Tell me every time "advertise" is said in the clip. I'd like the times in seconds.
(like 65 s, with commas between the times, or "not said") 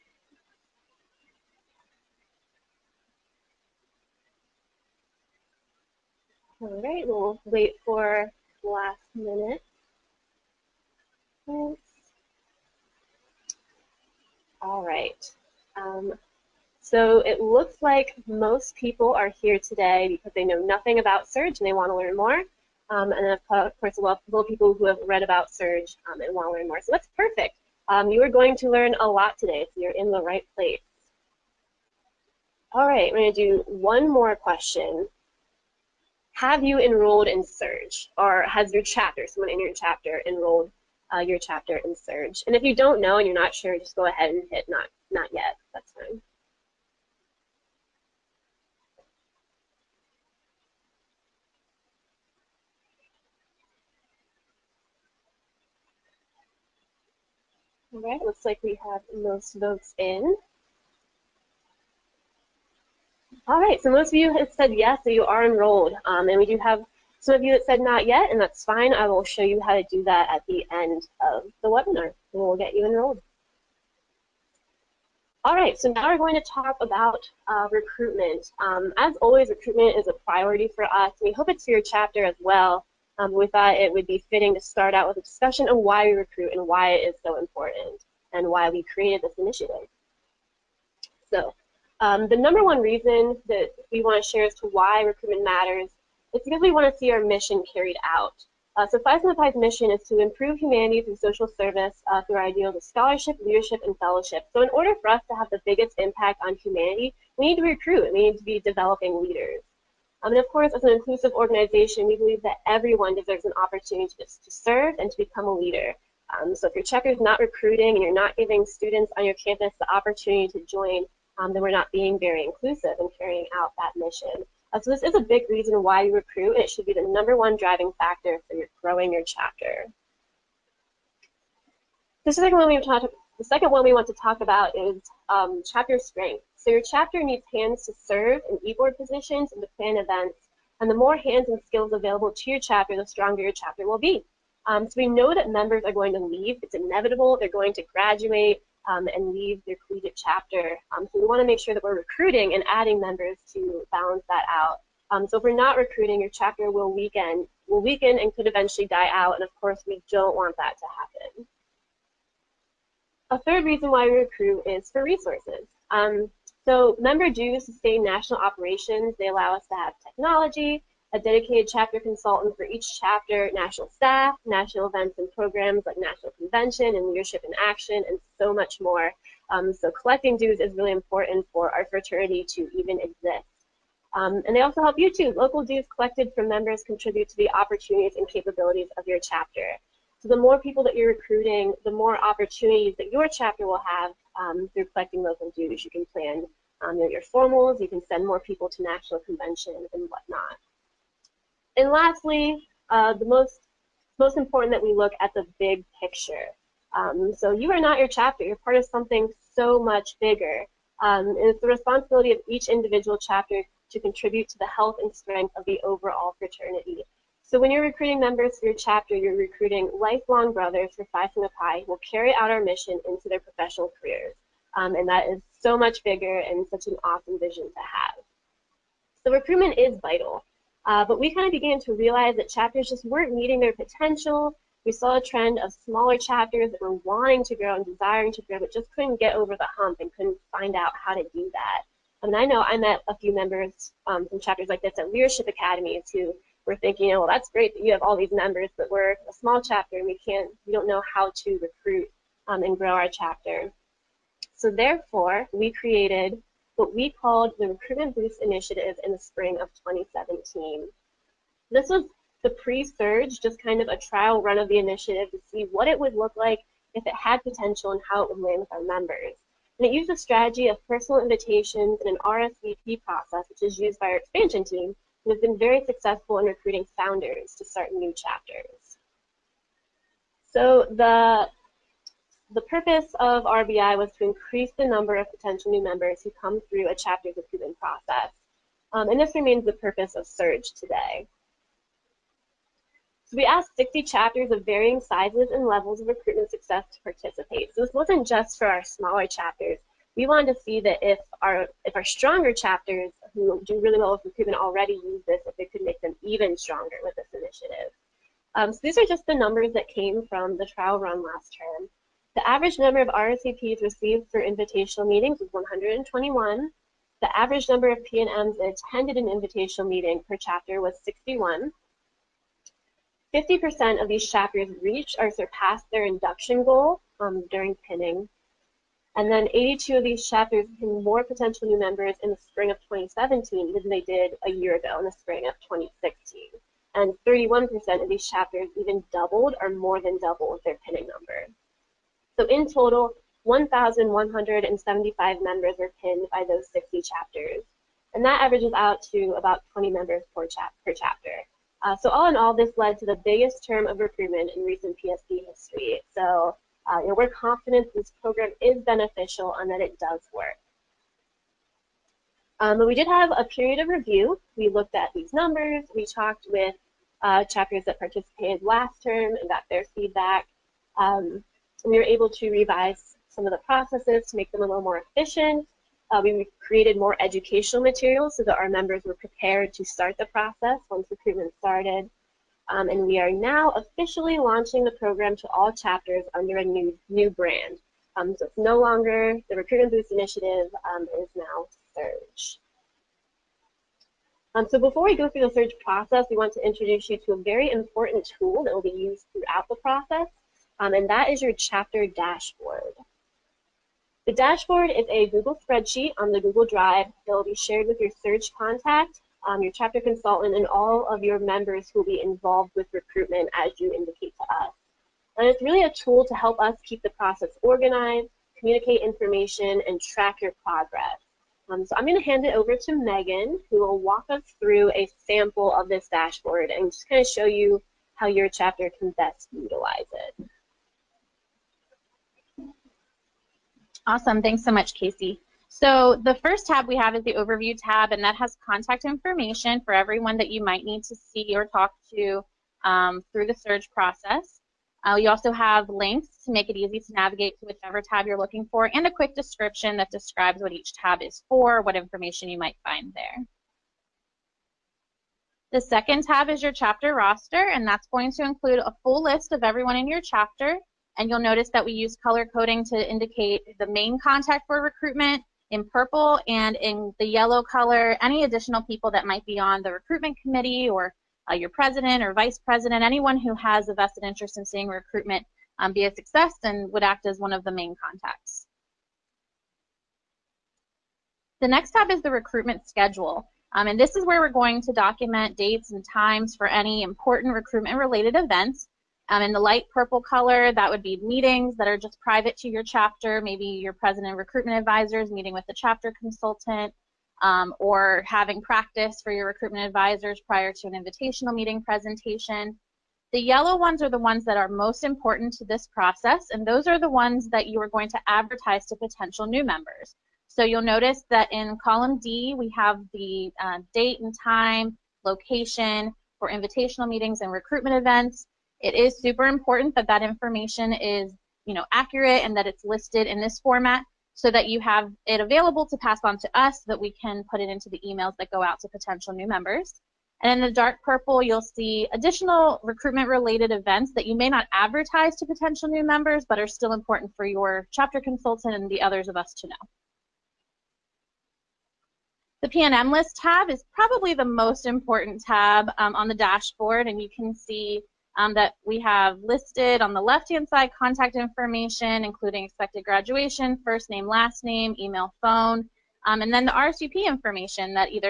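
508 s, 534 s.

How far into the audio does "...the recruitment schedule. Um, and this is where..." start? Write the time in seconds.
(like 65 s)
482 s.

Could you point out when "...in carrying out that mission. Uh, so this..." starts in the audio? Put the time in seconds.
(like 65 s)
122 s.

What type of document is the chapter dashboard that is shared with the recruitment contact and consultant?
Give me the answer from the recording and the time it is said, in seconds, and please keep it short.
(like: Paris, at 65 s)
Google spreadsheet, at 405 s.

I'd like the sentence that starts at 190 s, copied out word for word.
So the more people that you're recruiting, the more opportunities that your chapter will have um, through collecting local dues.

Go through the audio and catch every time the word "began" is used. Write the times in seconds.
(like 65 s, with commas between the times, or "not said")
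231 s.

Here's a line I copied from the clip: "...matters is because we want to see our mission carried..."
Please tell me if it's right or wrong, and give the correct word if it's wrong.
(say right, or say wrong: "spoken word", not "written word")
right.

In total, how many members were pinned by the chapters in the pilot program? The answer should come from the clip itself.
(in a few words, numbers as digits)
1,175.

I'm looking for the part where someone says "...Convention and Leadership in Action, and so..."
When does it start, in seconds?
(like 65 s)
176 s.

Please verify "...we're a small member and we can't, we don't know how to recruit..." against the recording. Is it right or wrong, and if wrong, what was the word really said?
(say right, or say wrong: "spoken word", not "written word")
wrong: "chapter", not "member".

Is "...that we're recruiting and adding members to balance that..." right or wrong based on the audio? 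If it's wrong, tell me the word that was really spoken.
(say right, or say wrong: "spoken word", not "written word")
right.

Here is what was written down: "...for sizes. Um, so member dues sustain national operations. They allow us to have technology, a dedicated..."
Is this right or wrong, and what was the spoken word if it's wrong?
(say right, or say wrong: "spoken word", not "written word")
wrong: "resources", not "sizes".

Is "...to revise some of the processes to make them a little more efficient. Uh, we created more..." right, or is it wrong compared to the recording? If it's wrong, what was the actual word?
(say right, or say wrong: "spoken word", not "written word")
right.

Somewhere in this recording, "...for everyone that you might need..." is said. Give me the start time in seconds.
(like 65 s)
439 s.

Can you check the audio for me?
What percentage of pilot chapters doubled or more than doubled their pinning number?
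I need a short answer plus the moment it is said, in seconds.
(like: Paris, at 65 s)
31%, at 337 s.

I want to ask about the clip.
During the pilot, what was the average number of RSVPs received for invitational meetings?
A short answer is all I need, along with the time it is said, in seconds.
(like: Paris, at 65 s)
121, at 315 s.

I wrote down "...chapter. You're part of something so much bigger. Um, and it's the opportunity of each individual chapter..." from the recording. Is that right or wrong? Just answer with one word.
wrong.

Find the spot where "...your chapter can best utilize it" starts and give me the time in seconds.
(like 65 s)
428 s.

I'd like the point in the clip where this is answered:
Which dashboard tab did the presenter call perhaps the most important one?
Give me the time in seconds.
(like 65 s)
542 s.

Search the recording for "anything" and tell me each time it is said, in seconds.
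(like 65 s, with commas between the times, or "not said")
not said.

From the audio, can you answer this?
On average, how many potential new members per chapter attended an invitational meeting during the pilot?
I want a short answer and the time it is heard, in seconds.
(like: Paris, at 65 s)
61, at 321 s.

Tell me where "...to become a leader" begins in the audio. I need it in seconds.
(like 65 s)
115 s.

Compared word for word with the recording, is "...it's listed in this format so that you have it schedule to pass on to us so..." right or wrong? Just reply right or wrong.
wrong.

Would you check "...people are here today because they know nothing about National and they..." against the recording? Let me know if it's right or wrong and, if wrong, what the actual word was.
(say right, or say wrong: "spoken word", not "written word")
wrong: "Surge", not "National".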